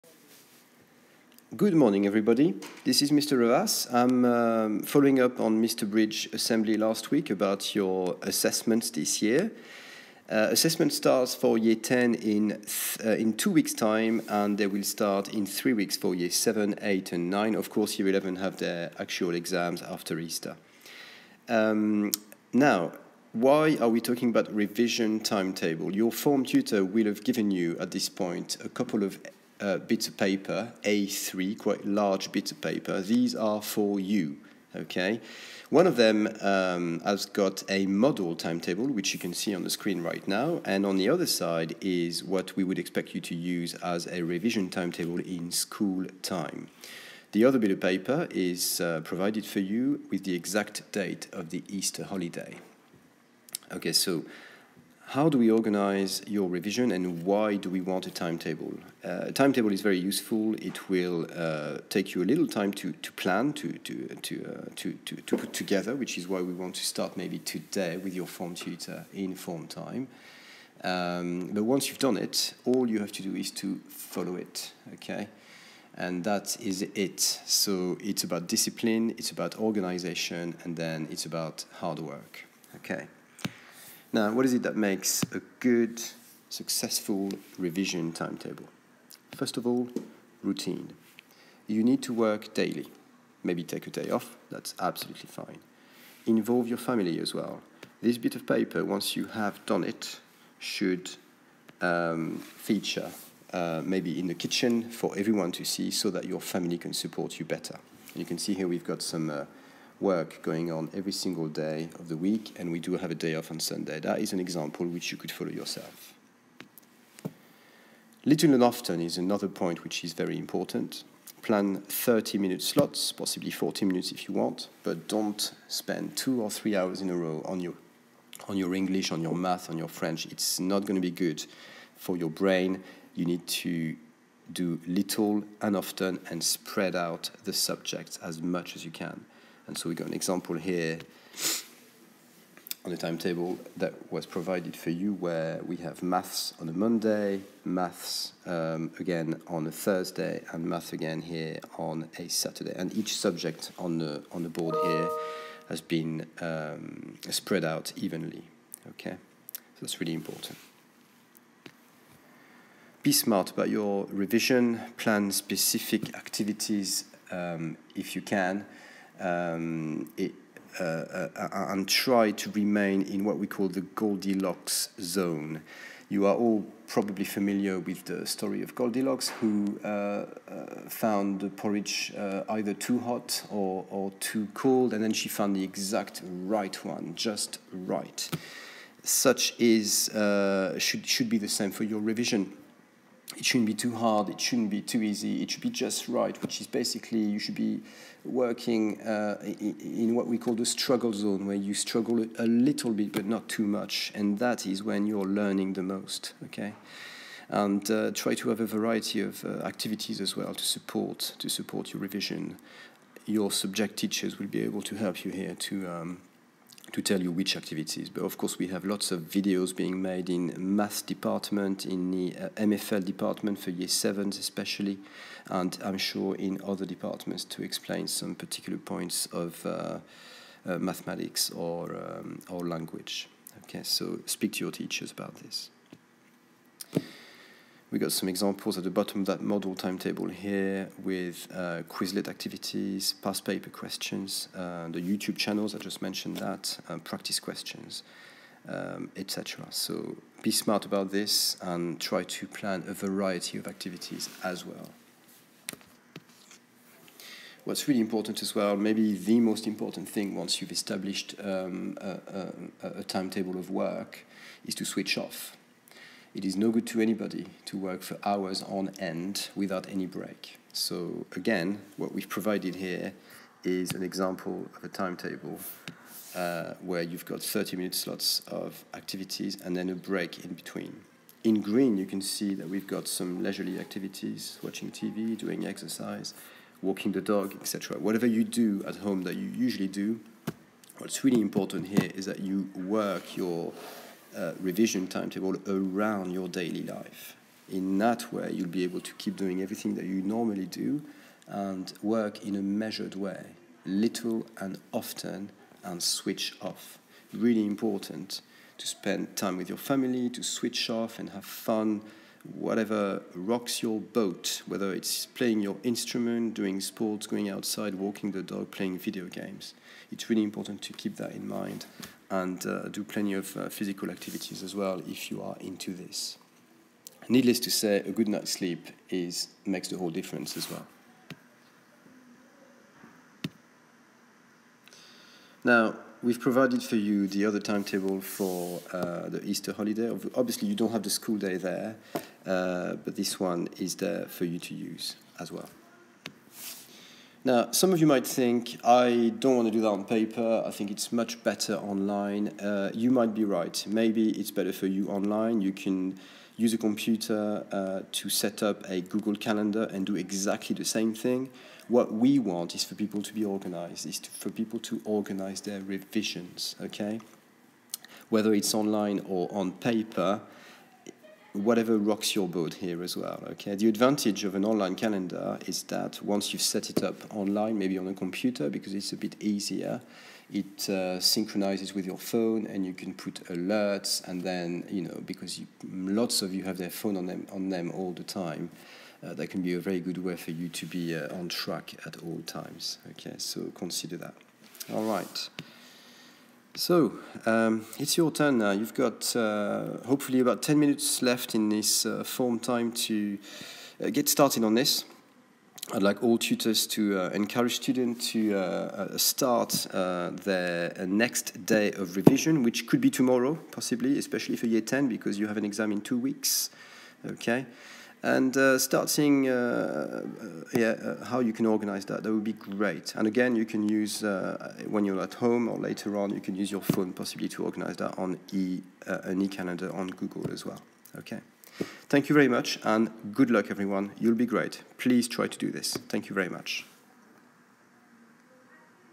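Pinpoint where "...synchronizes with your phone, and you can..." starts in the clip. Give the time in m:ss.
6:21.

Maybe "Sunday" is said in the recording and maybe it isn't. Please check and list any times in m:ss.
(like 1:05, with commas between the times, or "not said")
1:53.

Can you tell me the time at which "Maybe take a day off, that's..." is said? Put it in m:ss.
1:33.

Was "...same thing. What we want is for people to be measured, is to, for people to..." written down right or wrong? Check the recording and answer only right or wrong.
wrong.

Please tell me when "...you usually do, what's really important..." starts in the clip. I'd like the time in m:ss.
4:49.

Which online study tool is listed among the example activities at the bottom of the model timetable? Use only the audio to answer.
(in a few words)
Quizlet.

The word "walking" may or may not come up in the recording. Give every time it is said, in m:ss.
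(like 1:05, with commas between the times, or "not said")
4:46, 5:17.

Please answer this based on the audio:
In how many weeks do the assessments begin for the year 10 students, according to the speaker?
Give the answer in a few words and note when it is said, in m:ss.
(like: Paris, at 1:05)
2, at 0:13.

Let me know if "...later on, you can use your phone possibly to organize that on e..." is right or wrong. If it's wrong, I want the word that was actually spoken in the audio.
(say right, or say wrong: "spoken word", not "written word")
right.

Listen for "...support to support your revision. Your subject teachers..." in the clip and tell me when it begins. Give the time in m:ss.
3:30.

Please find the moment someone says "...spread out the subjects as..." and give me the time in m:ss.
2:16.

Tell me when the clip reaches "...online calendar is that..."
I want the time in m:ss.
6:14.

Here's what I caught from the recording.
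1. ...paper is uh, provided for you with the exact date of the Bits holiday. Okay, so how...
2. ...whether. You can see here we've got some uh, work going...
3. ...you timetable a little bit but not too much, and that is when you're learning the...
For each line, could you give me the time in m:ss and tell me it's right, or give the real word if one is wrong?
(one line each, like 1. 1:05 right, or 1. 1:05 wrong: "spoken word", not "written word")
1. 0:47 wrong: "Easter", not "Bits"
2. 1:47 wrong: "better", not "whether"
3. 3:21 wrong: "struggle", not "timetable".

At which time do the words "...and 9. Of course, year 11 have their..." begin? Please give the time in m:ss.
0:17.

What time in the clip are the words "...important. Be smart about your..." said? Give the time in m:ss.
2:40.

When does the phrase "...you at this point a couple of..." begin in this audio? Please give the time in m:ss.
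0:27.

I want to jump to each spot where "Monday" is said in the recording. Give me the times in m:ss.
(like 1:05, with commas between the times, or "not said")
2:26.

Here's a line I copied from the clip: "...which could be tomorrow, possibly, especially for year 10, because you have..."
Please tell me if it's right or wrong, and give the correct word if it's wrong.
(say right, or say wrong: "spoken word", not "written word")
right.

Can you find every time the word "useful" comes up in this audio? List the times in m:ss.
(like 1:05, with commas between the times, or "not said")
0:59.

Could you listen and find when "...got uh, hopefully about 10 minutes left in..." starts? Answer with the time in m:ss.
6:38.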